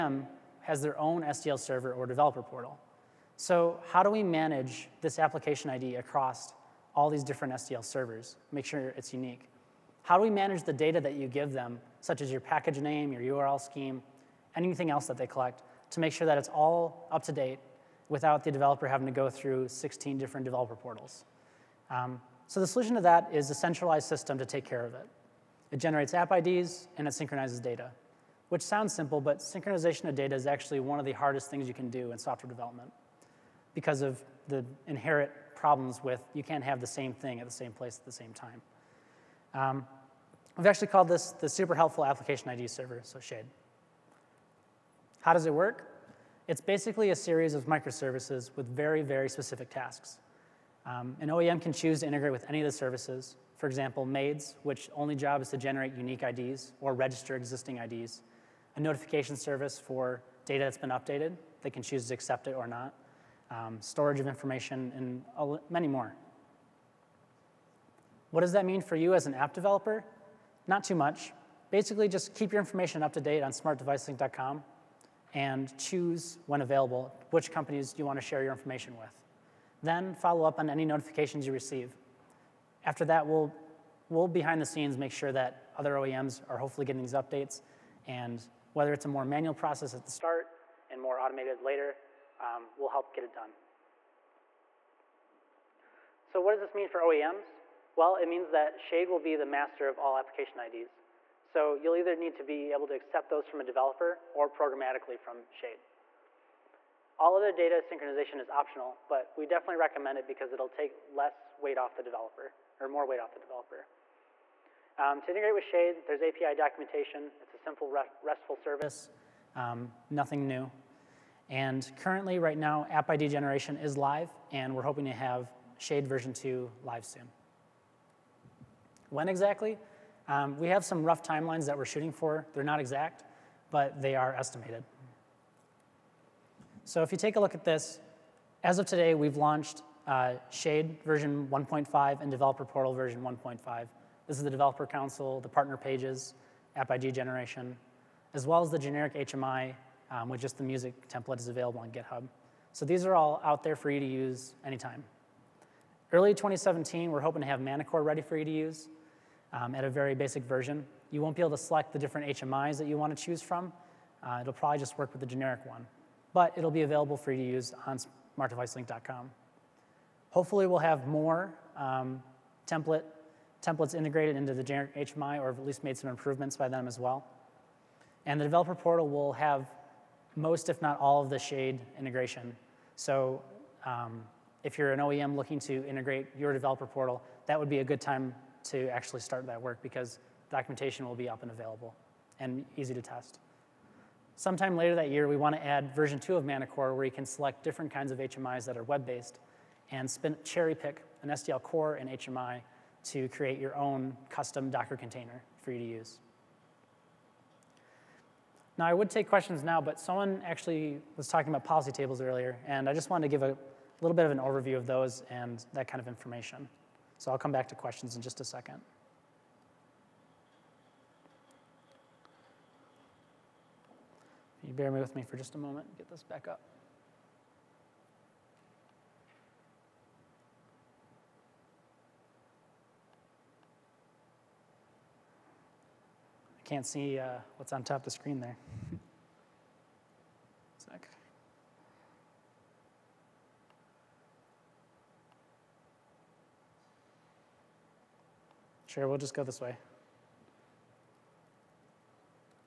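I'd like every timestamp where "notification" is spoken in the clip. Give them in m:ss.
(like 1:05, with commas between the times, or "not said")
0:58, 1:20.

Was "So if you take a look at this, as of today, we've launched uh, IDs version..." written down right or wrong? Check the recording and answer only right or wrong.
wrong.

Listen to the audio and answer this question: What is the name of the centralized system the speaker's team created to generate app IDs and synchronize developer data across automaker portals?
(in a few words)
Super helpful application ID server.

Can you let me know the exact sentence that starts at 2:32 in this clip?
So these are all out there for you to use anytime.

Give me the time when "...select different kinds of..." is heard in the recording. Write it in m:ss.
3:17.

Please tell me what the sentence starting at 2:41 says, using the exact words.
You won't be able to select the different HMIs that you want to choose from.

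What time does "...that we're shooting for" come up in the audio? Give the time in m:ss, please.
2:11.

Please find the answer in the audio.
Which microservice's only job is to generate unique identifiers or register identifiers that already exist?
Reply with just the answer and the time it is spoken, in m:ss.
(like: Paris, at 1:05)
MAIDS, at 0:54.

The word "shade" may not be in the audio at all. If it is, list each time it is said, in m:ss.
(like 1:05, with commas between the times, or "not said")
0:43, 1:38, 1:45, 1:55, 2:05, 2:20, 3:01.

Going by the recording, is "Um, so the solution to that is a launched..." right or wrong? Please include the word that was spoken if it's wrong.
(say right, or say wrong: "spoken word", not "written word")
wrong: "centralized", not "launched".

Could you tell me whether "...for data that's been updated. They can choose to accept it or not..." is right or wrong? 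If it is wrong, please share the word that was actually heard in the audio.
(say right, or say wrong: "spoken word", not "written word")
right.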